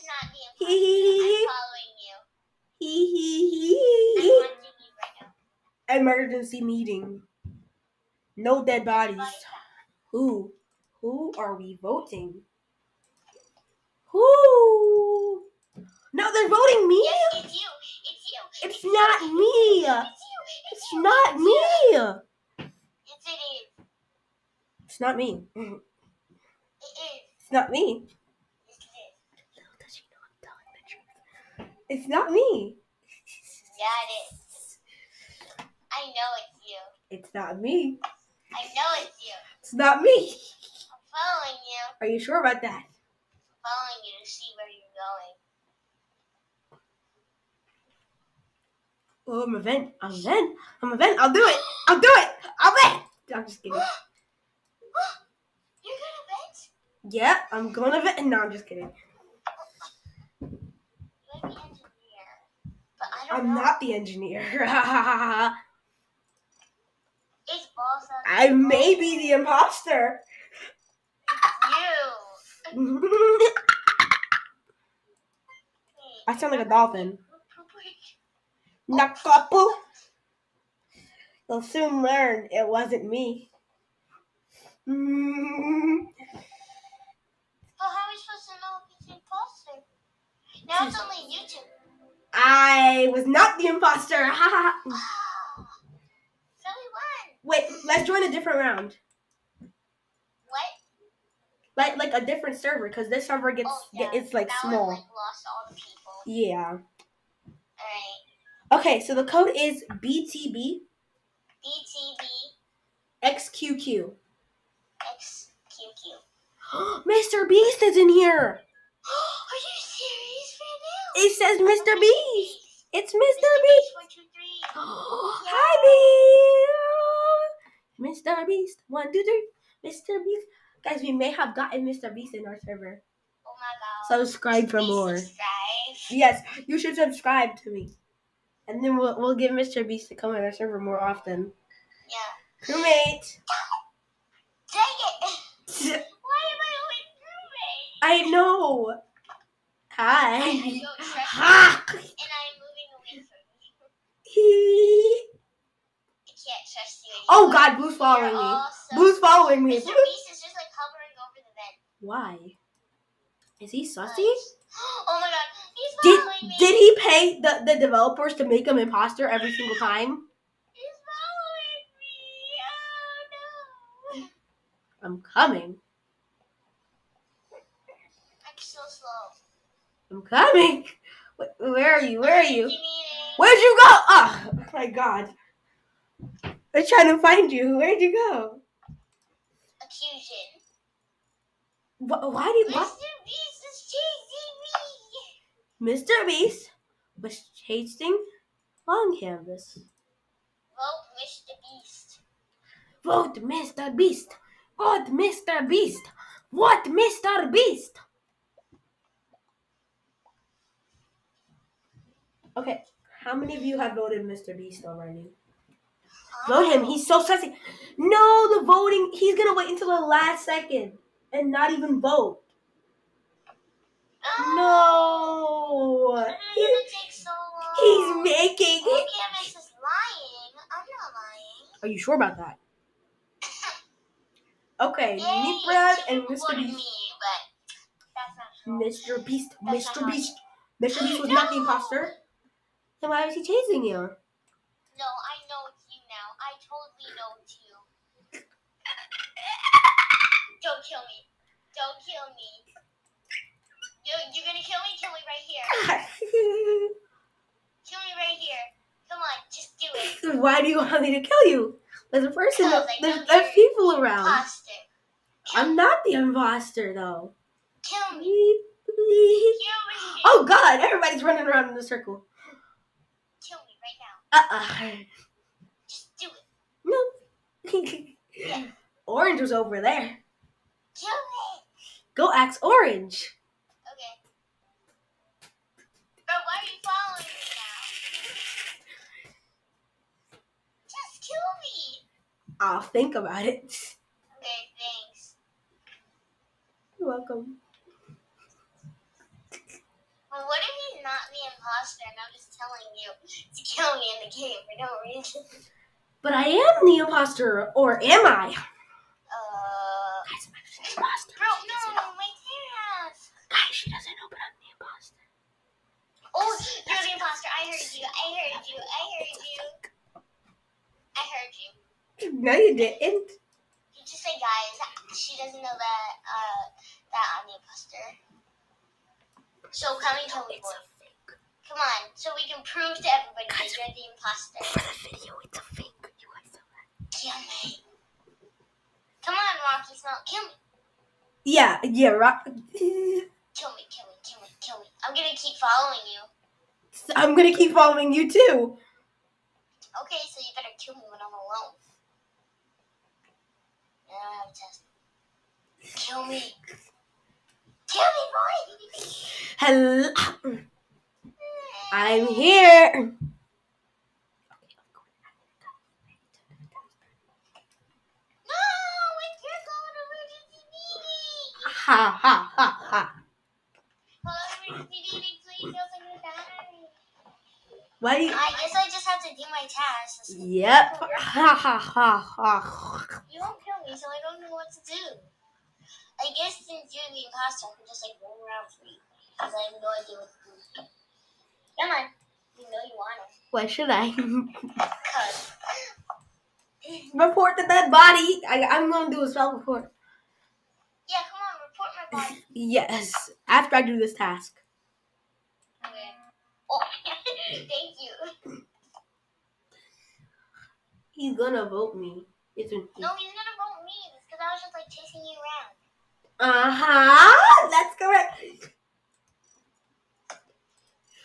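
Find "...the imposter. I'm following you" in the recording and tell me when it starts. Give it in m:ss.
0:00.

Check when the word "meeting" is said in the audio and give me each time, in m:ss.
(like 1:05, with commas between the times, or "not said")
0:06.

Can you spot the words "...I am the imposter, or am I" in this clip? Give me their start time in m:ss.
5:06.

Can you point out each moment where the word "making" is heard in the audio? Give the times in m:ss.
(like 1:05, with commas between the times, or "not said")
3:48.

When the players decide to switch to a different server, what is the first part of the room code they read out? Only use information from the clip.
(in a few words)
BTB.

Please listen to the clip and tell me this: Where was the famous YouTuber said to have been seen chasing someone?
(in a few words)
Long Canvas.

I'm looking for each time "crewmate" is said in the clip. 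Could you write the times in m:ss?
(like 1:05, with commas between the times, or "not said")
2:22, 2:27.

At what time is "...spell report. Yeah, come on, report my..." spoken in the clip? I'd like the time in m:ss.
6:39.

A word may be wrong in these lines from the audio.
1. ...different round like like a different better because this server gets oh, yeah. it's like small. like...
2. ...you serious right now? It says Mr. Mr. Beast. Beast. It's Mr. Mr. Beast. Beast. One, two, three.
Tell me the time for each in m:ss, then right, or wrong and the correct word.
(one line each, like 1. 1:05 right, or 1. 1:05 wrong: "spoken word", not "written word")
1. 1:38 wrong: "server", not "better"
2. 1:59 right.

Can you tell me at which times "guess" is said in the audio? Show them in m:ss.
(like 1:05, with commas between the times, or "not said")
6:18, 6:26.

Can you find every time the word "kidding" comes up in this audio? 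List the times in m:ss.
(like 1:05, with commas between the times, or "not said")
0:53, 0:58.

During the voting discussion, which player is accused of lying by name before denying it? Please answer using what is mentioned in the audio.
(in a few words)
Amex.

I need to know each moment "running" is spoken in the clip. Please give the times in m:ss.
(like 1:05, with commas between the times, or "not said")
4:31.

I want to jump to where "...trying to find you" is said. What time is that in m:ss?
3:06.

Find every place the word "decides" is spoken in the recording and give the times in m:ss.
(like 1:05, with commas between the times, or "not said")
not said.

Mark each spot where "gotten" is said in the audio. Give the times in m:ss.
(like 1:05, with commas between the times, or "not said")
2:11.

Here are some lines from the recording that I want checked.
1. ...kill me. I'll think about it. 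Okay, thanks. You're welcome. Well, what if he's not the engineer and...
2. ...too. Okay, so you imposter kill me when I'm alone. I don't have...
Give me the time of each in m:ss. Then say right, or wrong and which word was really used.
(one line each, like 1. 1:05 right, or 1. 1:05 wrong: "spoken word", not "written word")
1. 4:51 wrong: "imposter", not "engineer"
2. 5:48 wrong: "better", not "imposter".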